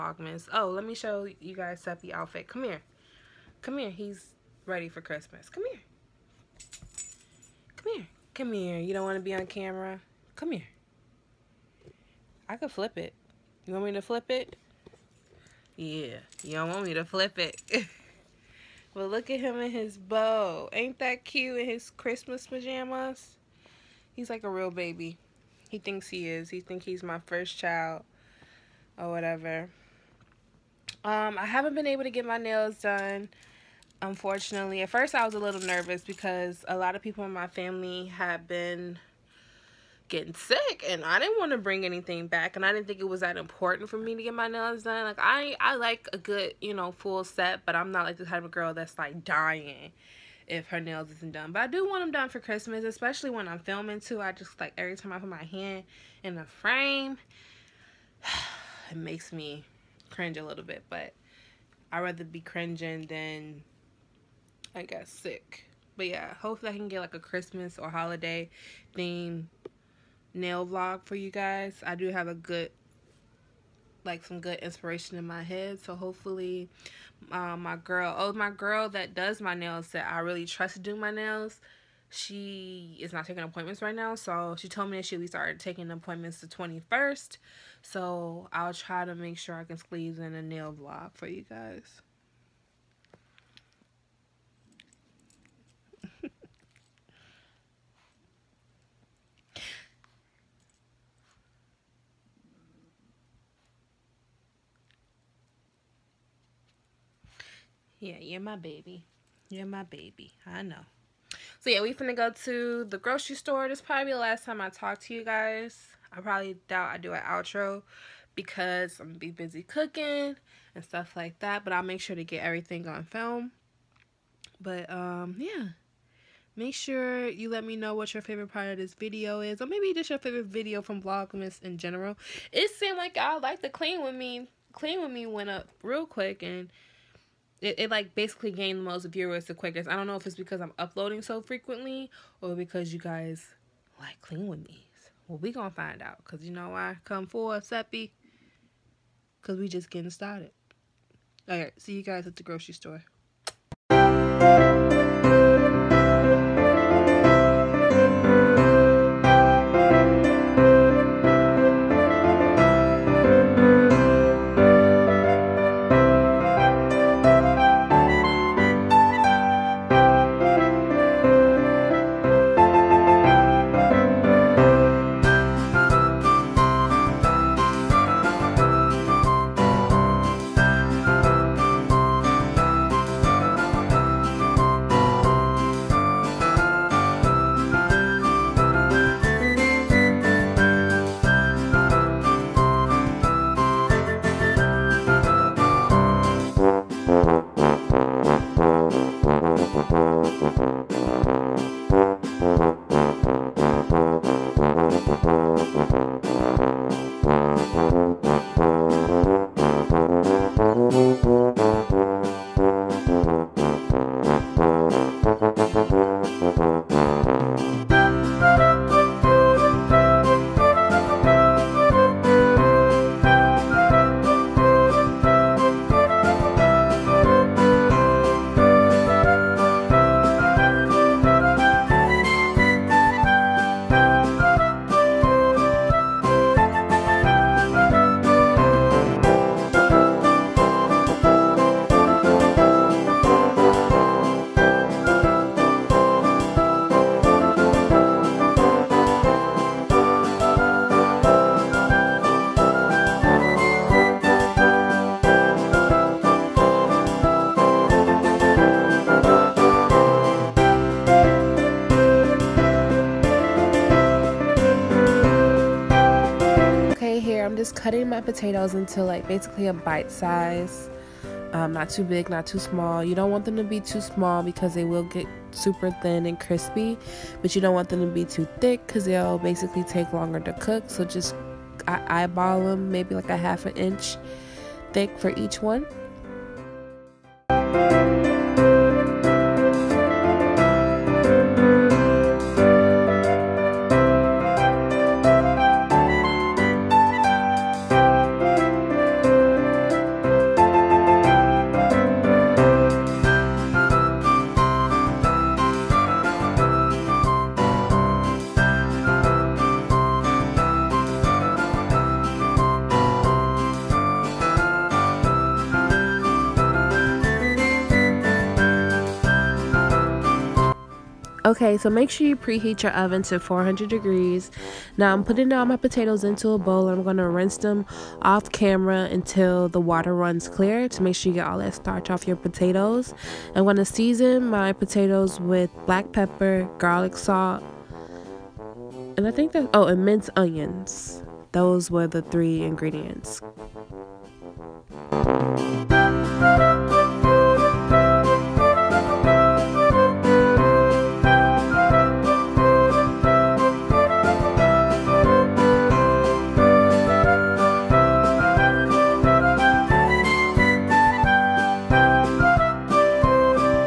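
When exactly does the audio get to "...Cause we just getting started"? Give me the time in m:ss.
2:29.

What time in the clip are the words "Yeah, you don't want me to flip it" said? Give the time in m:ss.
0:15.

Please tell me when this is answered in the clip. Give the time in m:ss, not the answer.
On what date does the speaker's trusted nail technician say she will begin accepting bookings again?
1:26.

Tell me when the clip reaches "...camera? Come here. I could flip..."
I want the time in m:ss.
0:09.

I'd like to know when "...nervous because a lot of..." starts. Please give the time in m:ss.
0:35.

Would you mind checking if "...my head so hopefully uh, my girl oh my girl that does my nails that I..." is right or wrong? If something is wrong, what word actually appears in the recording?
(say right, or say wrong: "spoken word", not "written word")
right.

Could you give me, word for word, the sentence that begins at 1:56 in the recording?
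I probably doubt I do an outro because I'm gonna be busy cooking and stuff like that.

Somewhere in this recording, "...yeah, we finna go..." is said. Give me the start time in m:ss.
1:51.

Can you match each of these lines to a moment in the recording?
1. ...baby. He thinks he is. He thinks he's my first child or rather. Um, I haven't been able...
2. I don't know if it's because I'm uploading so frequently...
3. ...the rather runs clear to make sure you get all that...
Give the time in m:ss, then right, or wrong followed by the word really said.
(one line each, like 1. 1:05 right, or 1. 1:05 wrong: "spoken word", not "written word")
1. 0:24 wrong: "whatever", not "rather"
2. 2:19 right
3. 5:29 wrong: "water", not "rather".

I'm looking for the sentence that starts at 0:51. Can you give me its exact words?
But I do want them done for Christmas, especially when I'm filming too.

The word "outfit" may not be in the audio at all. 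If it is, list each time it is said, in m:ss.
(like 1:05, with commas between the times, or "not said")
0:02.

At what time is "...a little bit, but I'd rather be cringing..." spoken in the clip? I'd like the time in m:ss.
1:00.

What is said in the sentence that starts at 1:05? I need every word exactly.
But yeah, hopefully I can get like a Christmas or holiday theme nail vlog for you guys.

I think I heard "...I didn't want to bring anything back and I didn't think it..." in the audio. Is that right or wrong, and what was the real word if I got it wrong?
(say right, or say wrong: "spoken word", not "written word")
right.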